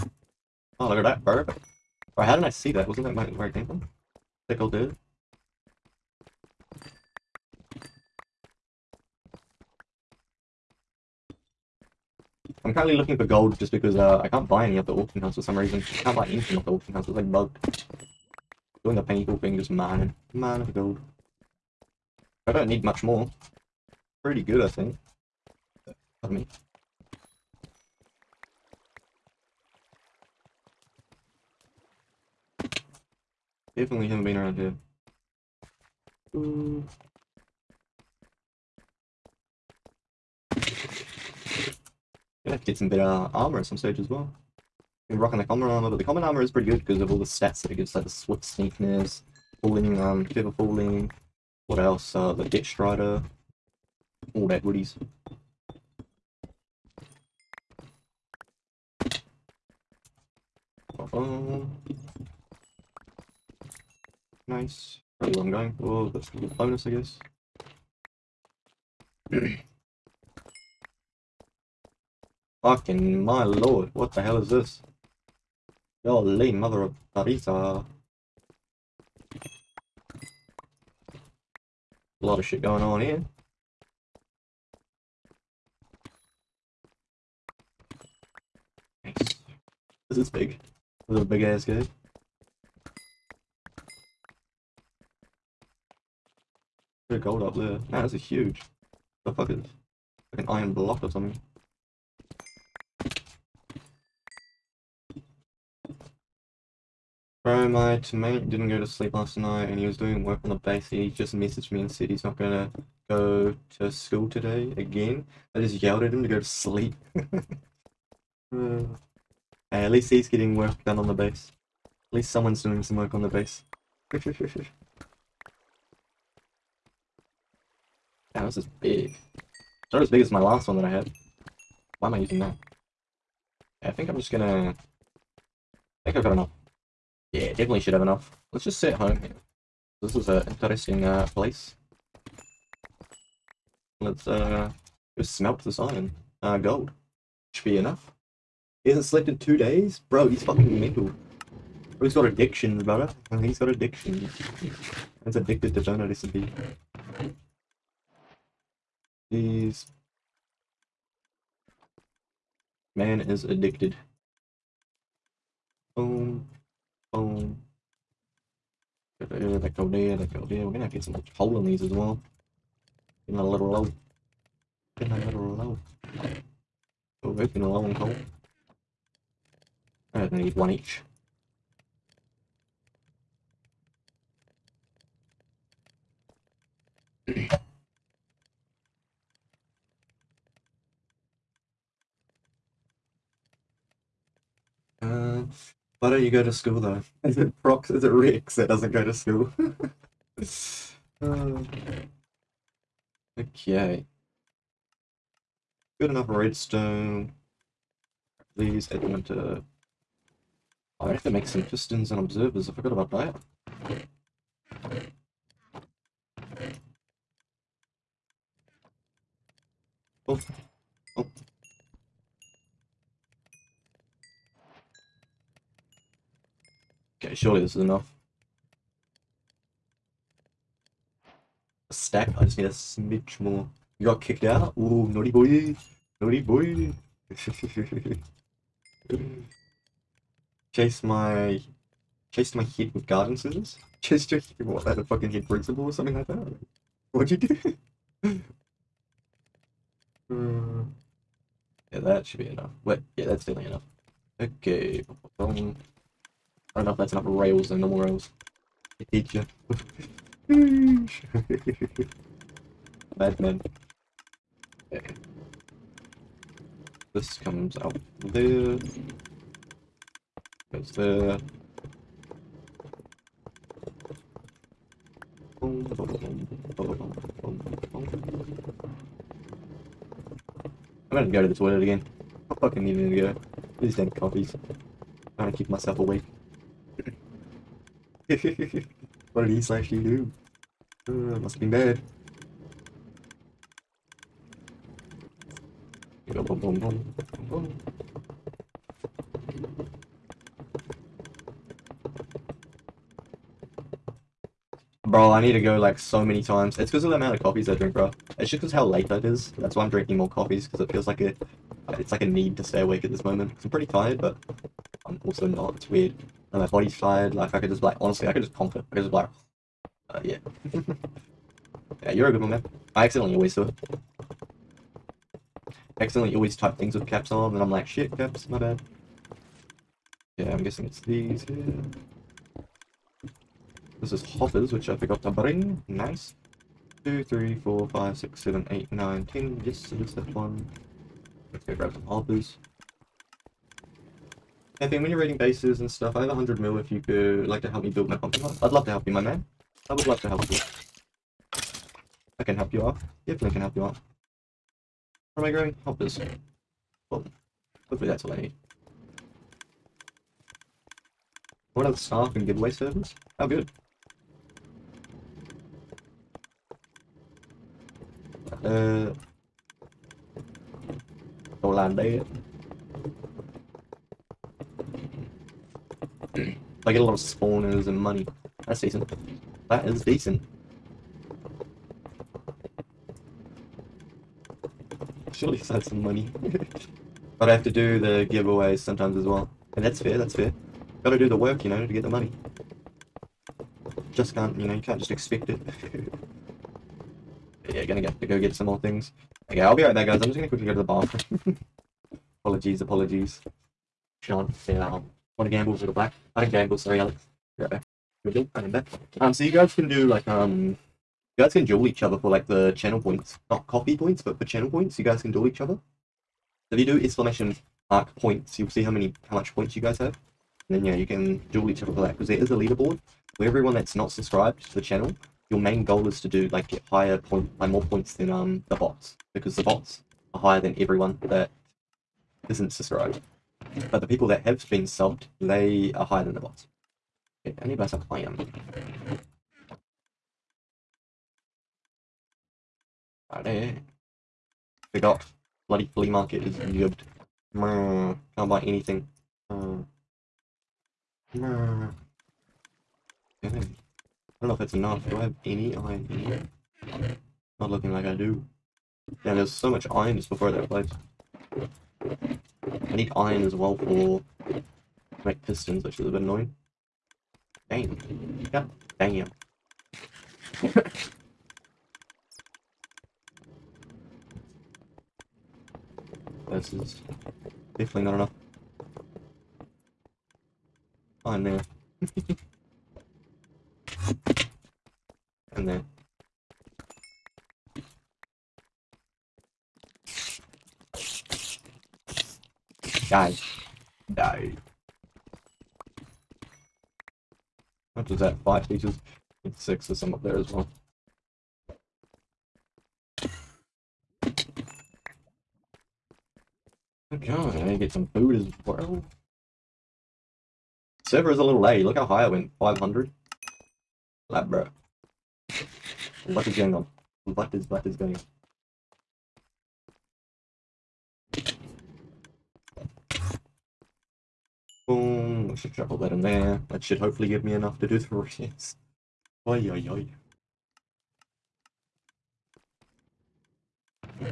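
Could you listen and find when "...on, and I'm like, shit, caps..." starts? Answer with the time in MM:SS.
05:27.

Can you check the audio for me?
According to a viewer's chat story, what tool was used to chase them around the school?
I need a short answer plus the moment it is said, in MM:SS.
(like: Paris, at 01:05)
Garden scissors, at 04:03.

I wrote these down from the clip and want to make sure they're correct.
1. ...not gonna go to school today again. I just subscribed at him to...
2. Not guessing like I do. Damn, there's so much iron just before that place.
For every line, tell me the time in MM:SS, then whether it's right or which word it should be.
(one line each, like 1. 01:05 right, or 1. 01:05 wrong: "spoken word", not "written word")
1. 01:52 wrong: "yelled", not "subscribed"
2. 07:37 wrong: "looking", not "guessing".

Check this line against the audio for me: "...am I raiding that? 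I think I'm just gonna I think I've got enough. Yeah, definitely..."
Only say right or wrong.
wrong.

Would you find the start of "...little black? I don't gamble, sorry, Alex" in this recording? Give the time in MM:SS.
06:45.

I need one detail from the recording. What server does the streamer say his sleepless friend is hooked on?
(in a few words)
Donut SMP.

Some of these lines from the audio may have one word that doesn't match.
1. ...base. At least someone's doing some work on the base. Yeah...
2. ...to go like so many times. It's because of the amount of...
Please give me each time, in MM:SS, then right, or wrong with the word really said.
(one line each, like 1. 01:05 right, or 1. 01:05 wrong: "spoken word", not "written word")
1. 02:01 right
2. 05:05 right.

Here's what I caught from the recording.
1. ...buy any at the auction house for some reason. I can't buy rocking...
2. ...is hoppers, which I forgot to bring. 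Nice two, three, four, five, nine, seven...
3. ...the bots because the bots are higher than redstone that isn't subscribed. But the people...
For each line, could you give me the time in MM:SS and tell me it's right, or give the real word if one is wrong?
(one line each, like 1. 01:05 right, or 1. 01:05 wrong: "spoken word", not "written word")
1. 00:14 wrong: "anything", not "rocking"
2. 05:34 wrong: "six", not "nine"
3. 07:08 wrong: "everyone", not "redstone".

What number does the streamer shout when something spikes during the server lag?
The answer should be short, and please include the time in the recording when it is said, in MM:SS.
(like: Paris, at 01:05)
500, at 08:32.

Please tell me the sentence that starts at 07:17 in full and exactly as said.
Okay, I need to buy some iron.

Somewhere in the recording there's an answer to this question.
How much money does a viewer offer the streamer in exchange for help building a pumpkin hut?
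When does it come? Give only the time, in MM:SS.
05:46.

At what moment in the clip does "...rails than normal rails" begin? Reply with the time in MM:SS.
04:17.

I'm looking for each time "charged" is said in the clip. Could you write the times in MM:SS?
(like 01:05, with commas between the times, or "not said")
not said.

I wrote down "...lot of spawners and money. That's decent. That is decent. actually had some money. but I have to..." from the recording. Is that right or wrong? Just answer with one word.
right.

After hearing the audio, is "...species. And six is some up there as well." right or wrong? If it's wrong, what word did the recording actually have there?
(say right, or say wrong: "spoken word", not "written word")
right.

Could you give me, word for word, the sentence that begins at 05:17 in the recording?
Like I could just like honestly, I could just conquer.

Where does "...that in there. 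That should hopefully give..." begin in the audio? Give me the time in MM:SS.
08:45.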